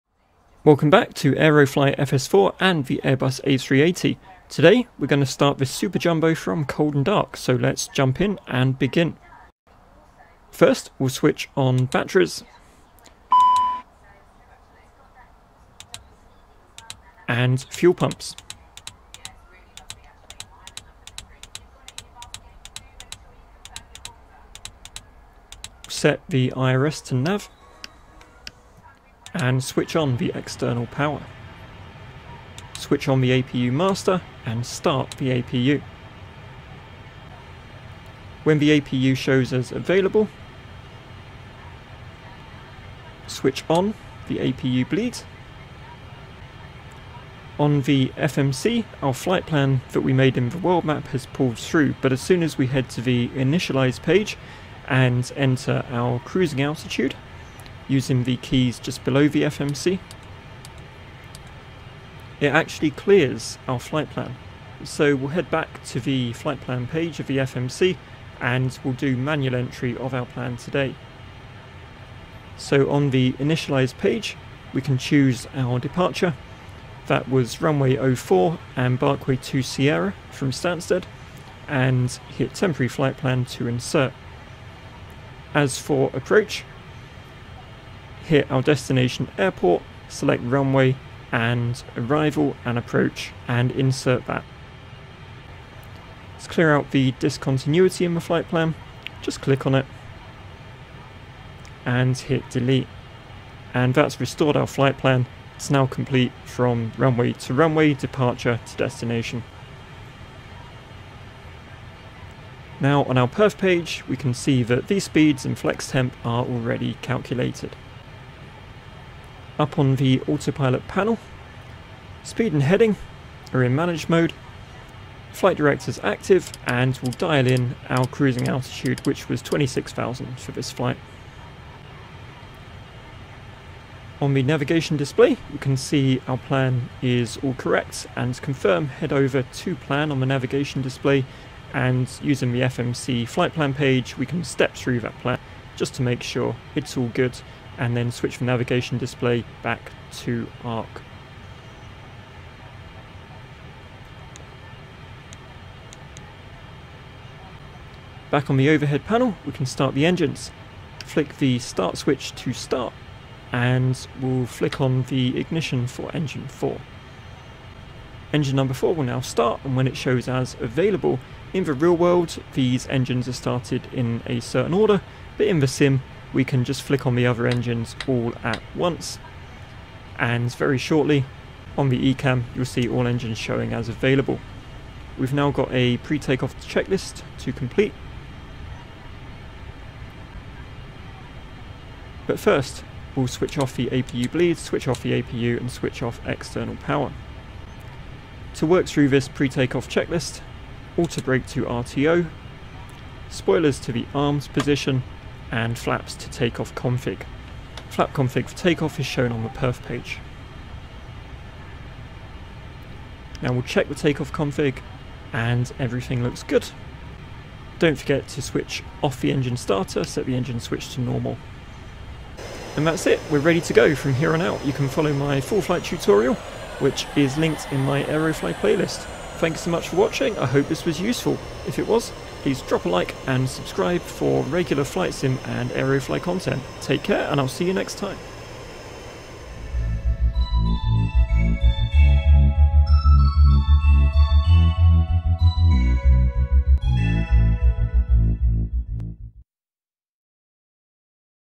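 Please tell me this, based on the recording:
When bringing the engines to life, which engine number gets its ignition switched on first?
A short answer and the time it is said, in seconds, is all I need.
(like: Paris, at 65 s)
4, at 166 s.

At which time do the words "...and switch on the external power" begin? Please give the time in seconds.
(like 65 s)
29 s.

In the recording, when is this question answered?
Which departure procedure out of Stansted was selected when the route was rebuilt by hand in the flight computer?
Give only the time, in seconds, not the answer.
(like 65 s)
78 s.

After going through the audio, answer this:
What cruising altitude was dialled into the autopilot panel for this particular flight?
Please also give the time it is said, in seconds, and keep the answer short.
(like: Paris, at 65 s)
26,000, at 129 s.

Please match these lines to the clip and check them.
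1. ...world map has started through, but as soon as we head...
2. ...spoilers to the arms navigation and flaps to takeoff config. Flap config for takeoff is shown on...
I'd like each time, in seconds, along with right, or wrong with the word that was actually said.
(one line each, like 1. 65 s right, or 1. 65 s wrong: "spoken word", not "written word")
1. 50 s wrong: "pulled", not "started"
2. 203 s wrong: "position", not "navigation".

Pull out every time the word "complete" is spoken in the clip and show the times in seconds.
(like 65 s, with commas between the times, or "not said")
105 s, 187 s.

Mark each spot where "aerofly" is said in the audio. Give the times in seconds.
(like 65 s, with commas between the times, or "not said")
1 s, 228 s, 235 s.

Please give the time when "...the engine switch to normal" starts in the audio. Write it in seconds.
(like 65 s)
220 s.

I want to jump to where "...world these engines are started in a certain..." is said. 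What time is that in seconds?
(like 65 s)
171 s.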